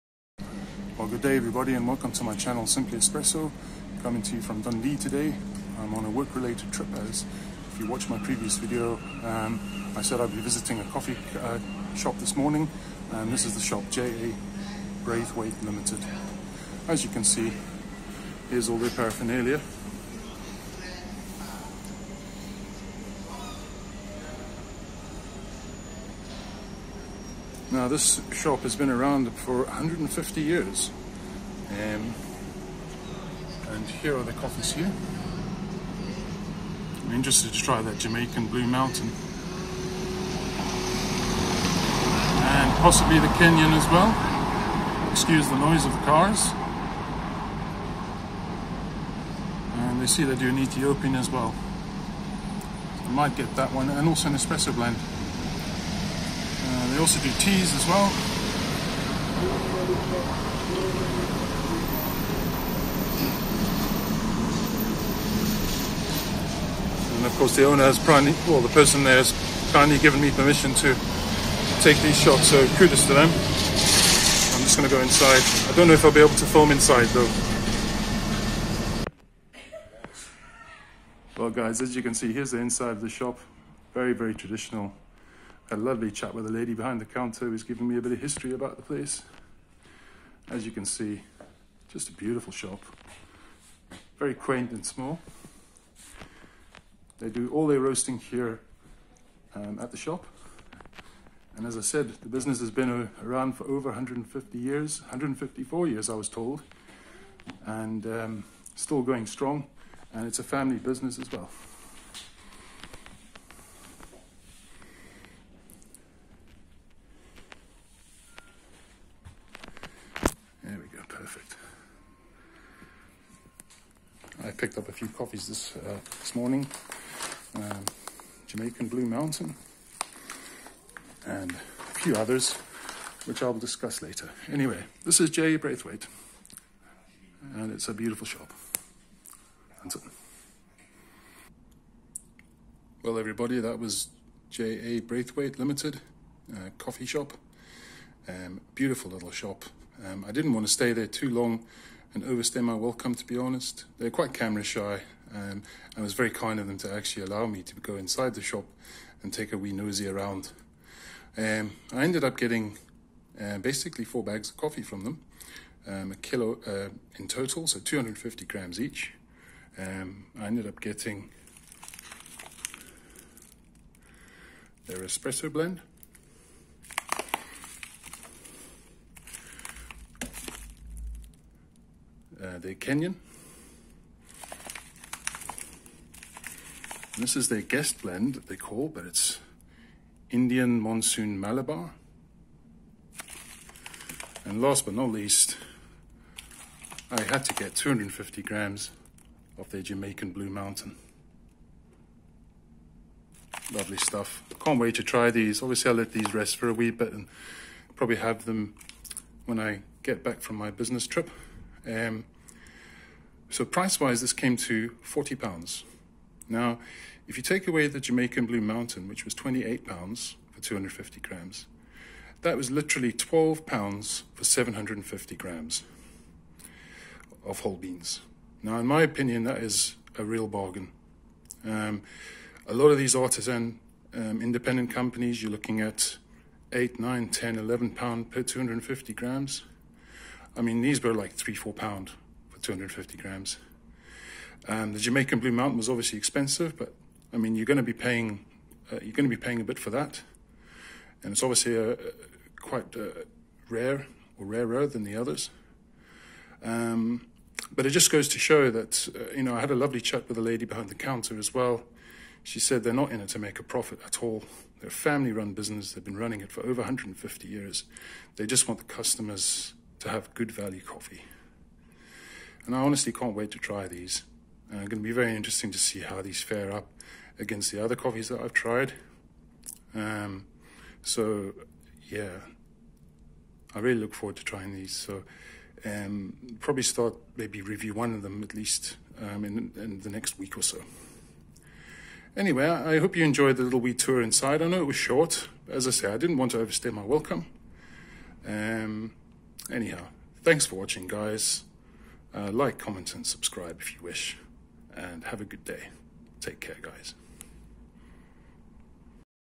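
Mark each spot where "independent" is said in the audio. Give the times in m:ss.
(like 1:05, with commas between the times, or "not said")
3:54.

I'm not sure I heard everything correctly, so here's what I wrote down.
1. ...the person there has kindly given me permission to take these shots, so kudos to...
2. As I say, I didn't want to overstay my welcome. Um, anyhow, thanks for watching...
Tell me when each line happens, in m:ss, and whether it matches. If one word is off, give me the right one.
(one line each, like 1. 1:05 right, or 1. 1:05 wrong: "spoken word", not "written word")
1. 1:08 right
2. 4:55 right.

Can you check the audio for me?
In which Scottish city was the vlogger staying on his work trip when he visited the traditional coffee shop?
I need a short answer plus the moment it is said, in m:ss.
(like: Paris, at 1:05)
Dundee, at 0:04.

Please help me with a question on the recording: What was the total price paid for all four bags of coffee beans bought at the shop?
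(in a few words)
40 pounds.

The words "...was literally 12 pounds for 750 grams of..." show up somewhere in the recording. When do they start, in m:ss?
3:42.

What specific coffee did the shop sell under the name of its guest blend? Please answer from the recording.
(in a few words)
Indian Monsoon Malabar.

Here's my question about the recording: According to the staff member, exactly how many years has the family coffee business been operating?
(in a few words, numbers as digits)
154 years.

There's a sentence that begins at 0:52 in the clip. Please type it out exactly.
So I might get that one and also an espresso blend also do teas as well.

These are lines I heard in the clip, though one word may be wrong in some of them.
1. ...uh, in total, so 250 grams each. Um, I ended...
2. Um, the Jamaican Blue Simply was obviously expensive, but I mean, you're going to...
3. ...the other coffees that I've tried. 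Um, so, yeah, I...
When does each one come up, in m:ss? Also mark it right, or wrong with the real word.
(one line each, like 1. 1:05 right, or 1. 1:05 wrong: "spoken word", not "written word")
1. 2:46 right
2. 4:04 wrong: "Mountain", not "Simply"
3. 4:37 right.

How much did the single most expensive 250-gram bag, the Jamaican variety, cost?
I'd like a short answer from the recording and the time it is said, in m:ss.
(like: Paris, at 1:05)
28 pounds, at 3:39.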